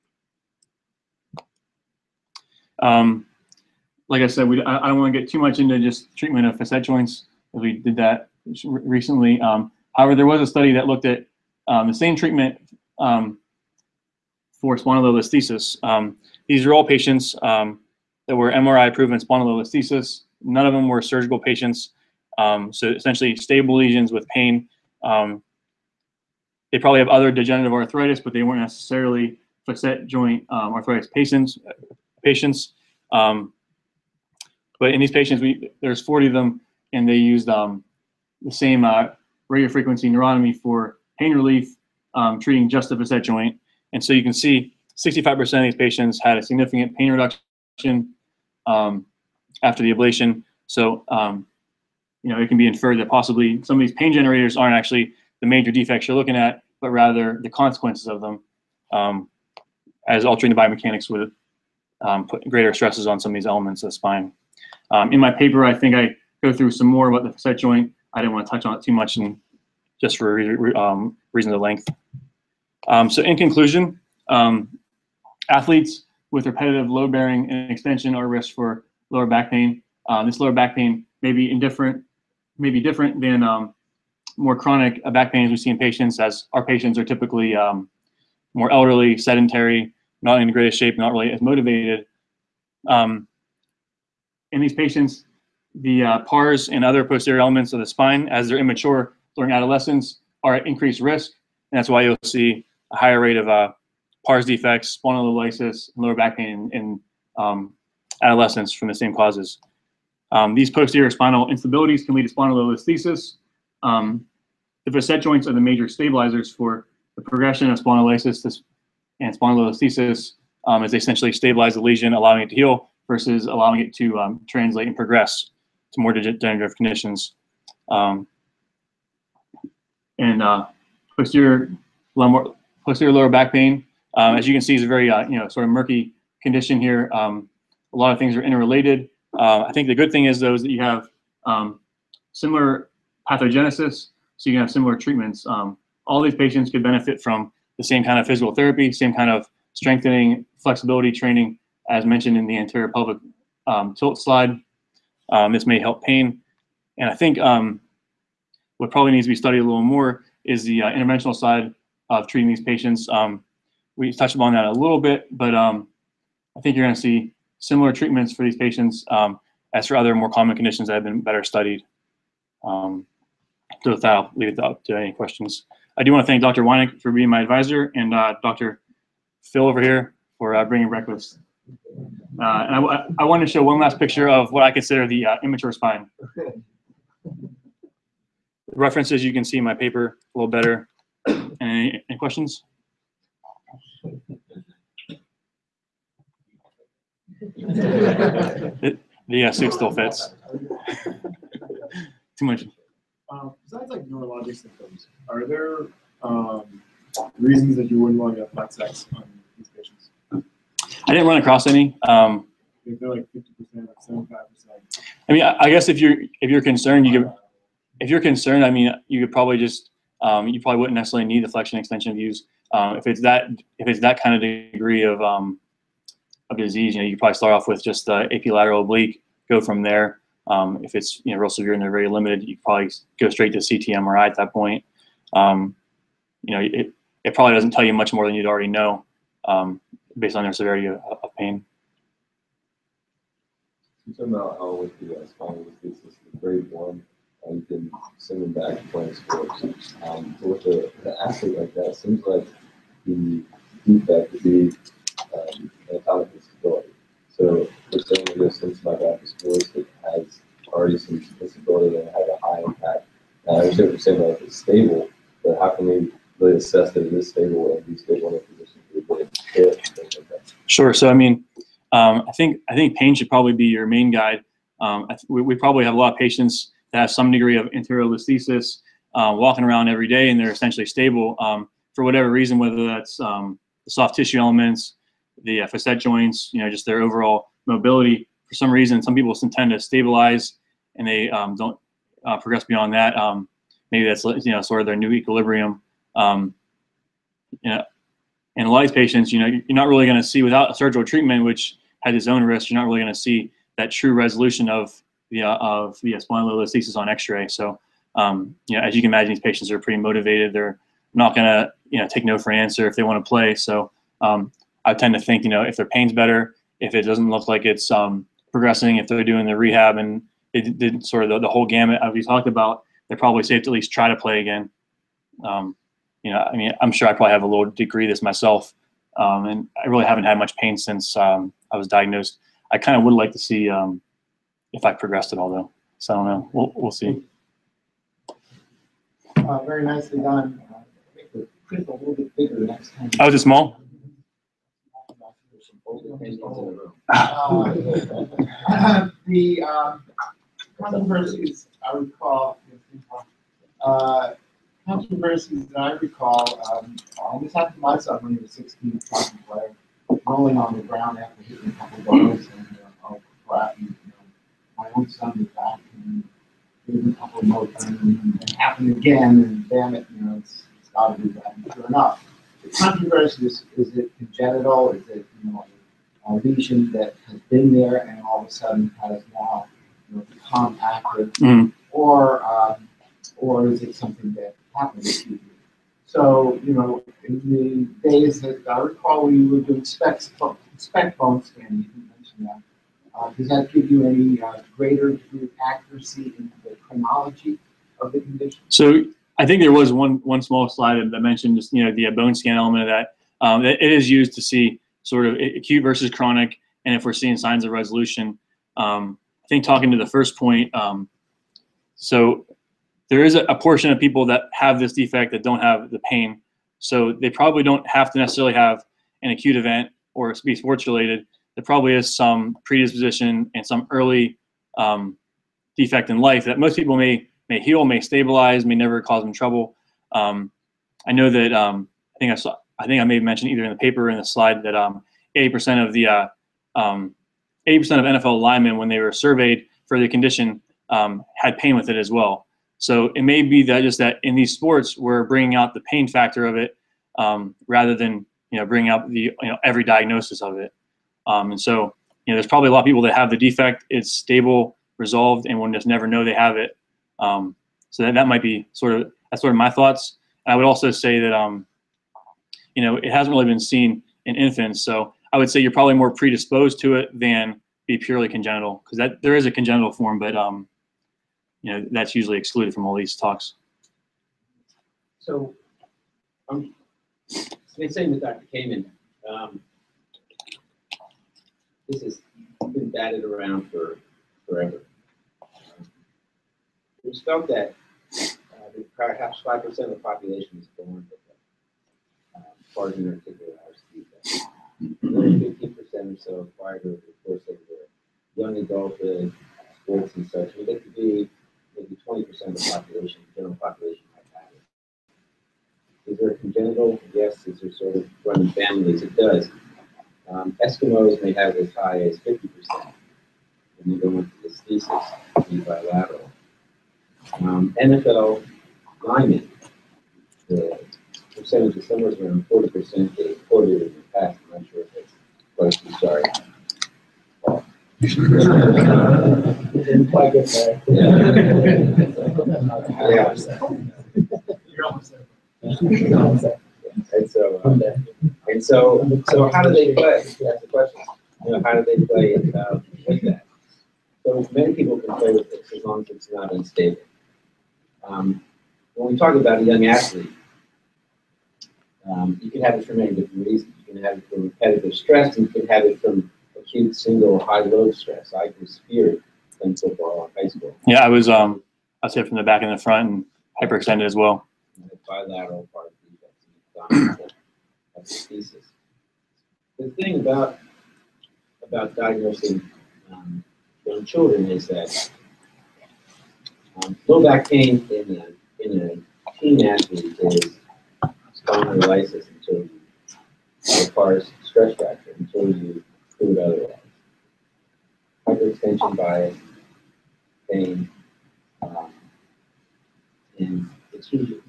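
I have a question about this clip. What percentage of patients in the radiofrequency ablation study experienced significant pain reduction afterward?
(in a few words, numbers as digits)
65%.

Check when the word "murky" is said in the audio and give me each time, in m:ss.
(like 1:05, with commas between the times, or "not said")
2:15.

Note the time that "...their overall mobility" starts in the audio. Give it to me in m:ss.
4:46.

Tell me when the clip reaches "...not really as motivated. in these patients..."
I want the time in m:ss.
1:30.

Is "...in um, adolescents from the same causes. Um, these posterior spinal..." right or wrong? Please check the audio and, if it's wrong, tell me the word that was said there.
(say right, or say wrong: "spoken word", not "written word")
right.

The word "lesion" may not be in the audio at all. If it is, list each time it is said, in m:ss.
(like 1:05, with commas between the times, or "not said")
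0:23, 2:01, 6:16.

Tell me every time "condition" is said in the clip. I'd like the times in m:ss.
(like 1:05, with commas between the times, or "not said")
2:06, 2:16, 2:50, 6:38, 7:20.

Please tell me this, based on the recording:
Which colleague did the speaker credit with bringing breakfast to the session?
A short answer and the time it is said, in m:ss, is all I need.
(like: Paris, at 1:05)
Dr. Phil, at 2:58.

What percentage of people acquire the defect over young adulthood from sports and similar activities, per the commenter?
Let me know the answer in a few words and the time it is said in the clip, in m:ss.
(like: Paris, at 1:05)
15%, at 8:15.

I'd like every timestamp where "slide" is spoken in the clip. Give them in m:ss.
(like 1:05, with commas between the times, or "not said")
2:34, 6:40, 7:14.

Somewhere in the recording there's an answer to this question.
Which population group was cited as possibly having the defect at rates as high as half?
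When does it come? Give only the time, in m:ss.
8:30.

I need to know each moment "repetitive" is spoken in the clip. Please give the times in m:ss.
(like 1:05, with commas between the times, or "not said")
1:16, 9:14.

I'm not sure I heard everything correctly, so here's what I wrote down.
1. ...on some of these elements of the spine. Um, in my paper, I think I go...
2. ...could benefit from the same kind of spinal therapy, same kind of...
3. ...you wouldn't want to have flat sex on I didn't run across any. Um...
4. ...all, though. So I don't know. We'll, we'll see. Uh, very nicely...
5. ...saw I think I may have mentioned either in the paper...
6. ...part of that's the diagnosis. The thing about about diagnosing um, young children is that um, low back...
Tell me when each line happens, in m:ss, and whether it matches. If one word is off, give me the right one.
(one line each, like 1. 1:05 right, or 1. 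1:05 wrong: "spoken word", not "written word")
1. 1:03 right
2. 2:26 wrong: "physical", not "spinal"
3. 3:27 right
4. 5:35 right
5. 7:12 right
6. 9:25 wrong: "thesis", not "diagnosis".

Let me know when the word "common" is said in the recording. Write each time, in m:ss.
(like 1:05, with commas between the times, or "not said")
2:50.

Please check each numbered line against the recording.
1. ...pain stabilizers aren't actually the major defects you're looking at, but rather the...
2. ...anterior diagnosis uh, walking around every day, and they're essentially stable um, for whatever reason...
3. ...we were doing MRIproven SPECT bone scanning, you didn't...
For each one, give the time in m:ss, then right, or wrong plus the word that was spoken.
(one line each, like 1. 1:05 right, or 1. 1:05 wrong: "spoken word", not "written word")
1. 0:53 wrong: "generators", not "stabilizers"
2. 4:37 wrong: "listhesis", not "diagnosis"
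3. 6:29 wrong: "SPECT", not "MRIproven".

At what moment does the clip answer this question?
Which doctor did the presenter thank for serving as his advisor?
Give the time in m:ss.
2:56.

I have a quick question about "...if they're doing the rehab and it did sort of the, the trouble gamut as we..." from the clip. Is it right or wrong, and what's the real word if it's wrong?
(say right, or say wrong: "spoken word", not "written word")
wrong: "whole", not "trouble".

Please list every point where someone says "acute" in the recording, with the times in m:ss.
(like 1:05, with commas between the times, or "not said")
6:45, 6:59, 9:16.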